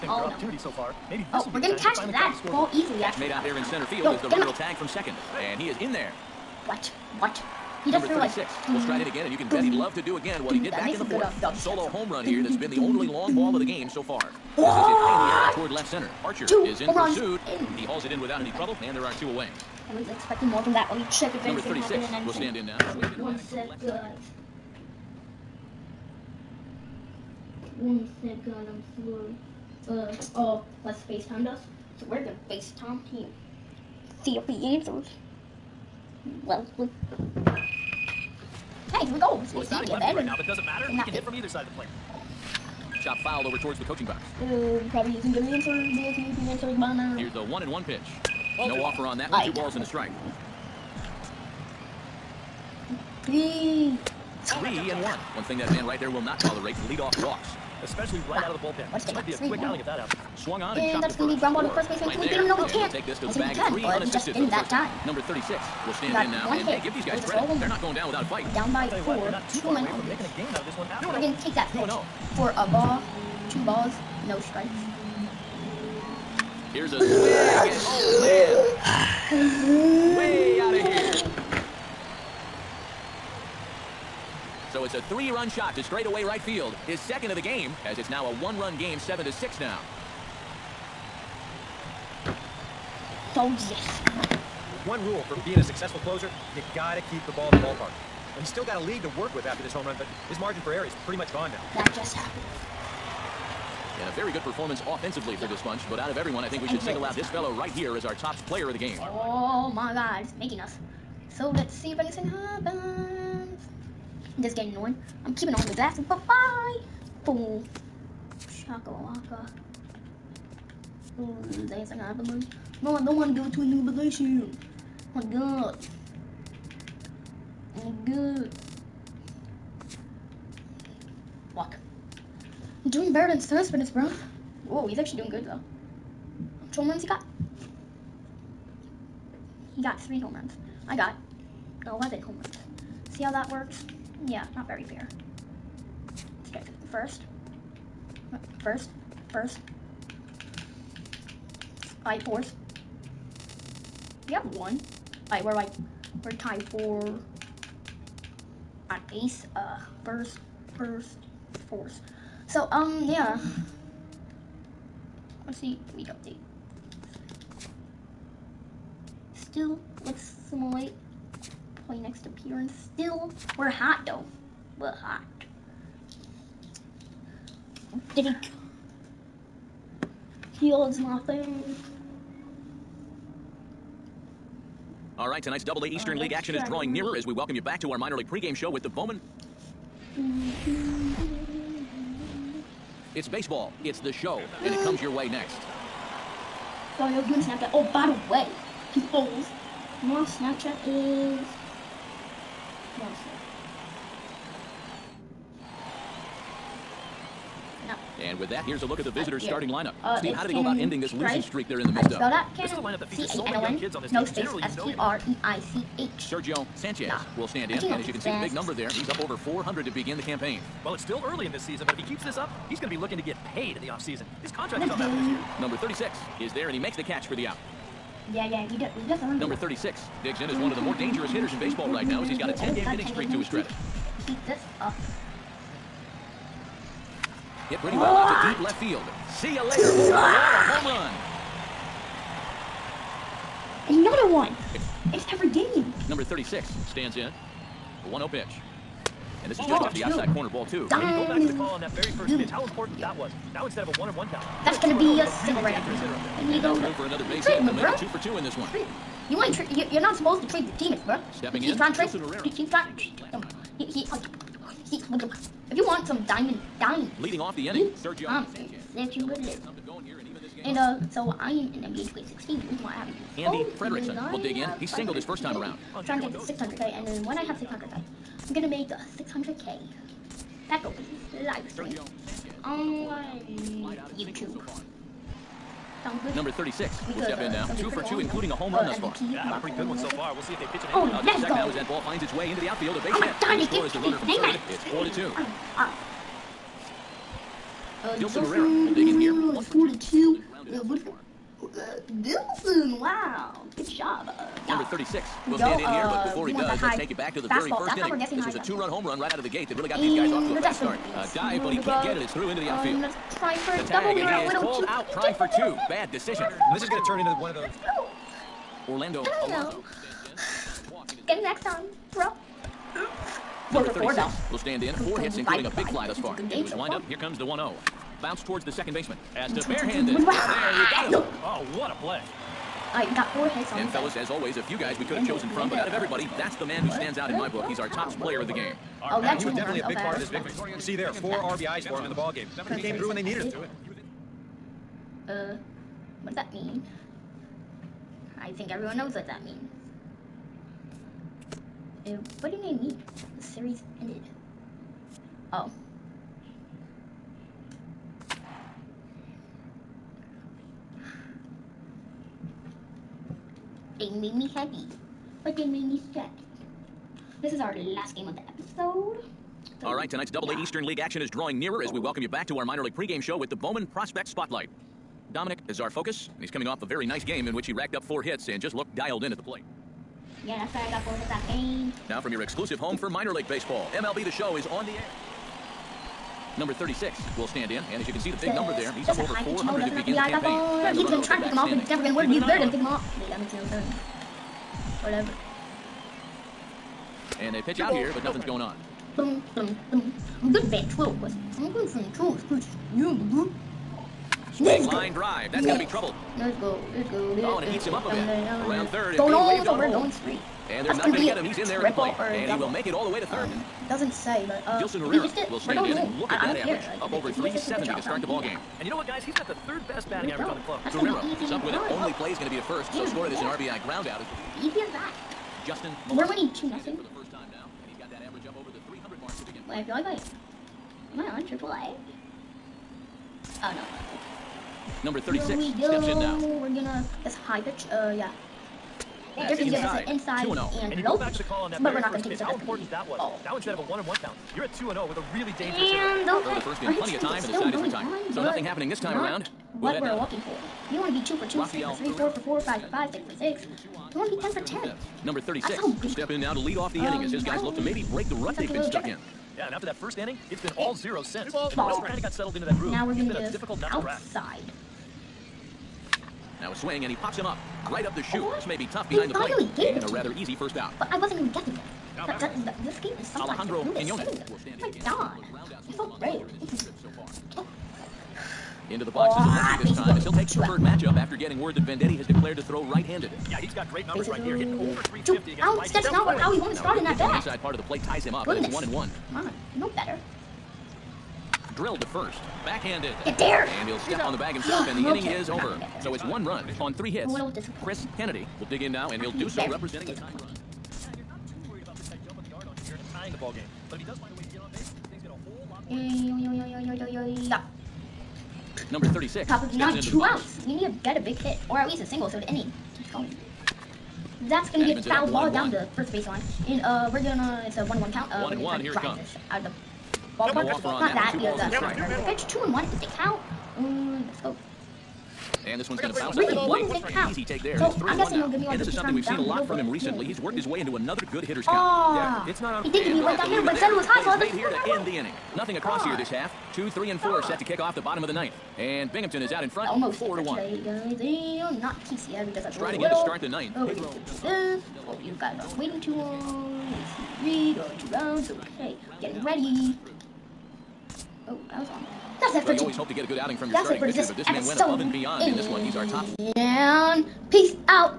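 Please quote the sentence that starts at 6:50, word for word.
And they're That's not going to get him.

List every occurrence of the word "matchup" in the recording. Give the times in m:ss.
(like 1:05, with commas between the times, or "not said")
8:00.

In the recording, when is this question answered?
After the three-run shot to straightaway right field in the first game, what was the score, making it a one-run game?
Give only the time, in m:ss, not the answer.
1:28.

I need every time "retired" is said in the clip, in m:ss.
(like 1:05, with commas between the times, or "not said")
7:27.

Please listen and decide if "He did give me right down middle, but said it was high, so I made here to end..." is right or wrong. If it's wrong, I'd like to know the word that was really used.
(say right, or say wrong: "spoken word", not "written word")
right.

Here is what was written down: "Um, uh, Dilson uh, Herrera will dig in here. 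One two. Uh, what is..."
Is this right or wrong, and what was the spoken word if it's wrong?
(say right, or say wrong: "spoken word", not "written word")
right.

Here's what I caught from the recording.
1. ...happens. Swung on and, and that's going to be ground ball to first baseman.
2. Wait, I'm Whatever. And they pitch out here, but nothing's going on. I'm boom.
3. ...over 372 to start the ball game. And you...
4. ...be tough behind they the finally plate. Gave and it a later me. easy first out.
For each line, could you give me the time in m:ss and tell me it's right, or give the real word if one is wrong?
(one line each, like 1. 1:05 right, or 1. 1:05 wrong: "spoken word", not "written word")
1. 0:59 right
2. 6:33 right
3. 6:57 wrong: "370", not "372"
4. 7:48 wrong: "rather", not "later".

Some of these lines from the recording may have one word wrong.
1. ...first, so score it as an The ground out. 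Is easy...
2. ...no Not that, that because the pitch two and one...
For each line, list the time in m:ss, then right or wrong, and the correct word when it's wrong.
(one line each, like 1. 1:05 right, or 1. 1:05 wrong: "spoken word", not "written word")
1. 7:02 wrong: "RBI", not "The"
2. 8:40 right.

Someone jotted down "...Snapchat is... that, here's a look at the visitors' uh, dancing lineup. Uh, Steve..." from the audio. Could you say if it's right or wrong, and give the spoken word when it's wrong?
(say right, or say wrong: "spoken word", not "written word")
wrong: "starting", not "dancing".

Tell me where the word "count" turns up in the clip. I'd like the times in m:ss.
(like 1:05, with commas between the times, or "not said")
4:14, 7:24, 8:38, 8:43, 8:51.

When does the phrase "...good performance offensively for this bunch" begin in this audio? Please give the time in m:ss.
1:44.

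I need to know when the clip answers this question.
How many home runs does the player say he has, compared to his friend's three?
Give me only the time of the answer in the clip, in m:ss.
2:21.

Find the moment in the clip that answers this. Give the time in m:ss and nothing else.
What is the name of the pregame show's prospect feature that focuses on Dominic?
6:13.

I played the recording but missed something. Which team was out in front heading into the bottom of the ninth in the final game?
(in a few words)
Binghamton.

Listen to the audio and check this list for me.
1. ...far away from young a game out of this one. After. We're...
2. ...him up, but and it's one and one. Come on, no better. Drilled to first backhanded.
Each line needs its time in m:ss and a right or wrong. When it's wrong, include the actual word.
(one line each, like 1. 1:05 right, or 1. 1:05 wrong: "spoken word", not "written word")
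1. 1:09 wrong: "making", not "young"
2. 8:08 right.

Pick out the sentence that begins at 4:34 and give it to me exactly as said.
He singled his first time around.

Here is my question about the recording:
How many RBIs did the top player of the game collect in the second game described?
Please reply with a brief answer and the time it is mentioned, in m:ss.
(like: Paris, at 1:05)
4, at 5:41.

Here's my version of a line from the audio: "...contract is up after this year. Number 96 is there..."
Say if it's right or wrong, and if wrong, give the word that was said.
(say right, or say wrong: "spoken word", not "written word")
wrong: "36", not "96".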